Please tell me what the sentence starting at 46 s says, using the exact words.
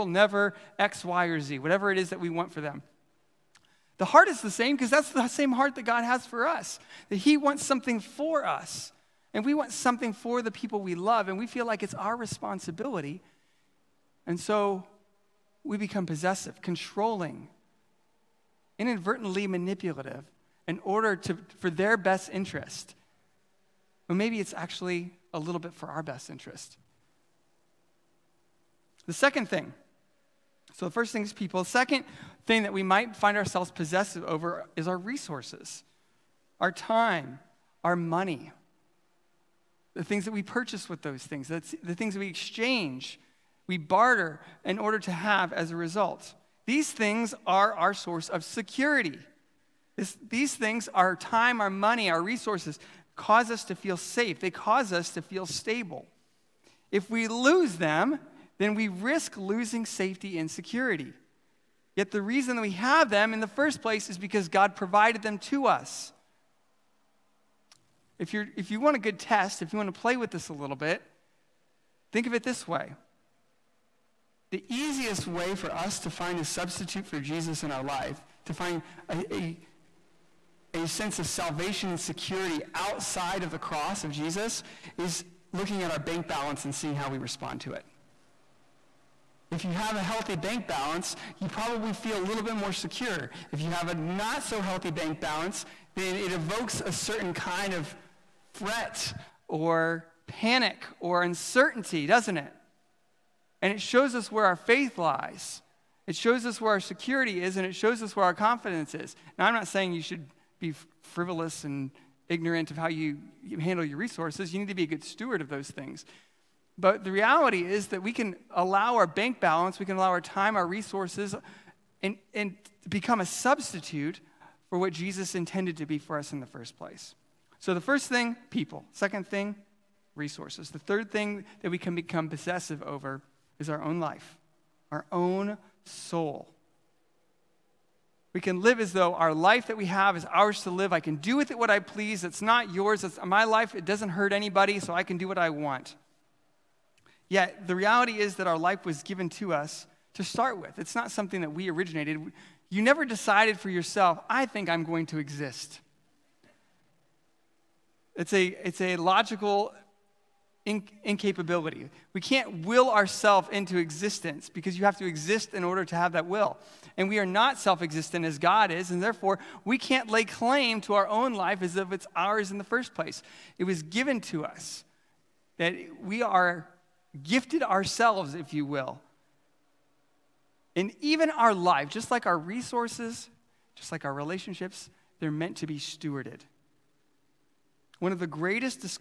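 These things are our source of security.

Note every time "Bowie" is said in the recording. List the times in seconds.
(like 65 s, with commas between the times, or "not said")
not said.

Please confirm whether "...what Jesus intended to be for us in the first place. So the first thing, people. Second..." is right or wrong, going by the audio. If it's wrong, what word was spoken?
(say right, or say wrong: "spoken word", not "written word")
right.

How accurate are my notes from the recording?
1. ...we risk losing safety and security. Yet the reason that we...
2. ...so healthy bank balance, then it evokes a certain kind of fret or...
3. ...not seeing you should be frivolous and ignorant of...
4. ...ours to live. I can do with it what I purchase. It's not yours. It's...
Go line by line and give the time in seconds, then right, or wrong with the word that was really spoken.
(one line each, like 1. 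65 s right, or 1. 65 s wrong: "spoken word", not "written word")
1. 58 s right
2. 94 s right
3. 109 s wrong: "saying", not "seeing"
4. 140 s wrong: "please", not "purchase".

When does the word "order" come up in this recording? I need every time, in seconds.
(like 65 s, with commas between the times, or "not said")
20 s, 44 s, 165 s.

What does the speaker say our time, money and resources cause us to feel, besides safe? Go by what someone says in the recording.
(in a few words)
Stable.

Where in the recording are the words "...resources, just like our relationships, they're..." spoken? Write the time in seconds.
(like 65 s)
182 s.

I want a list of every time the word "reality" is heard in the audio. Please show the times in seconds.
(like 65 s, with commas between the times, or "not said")
117 s, 147 s.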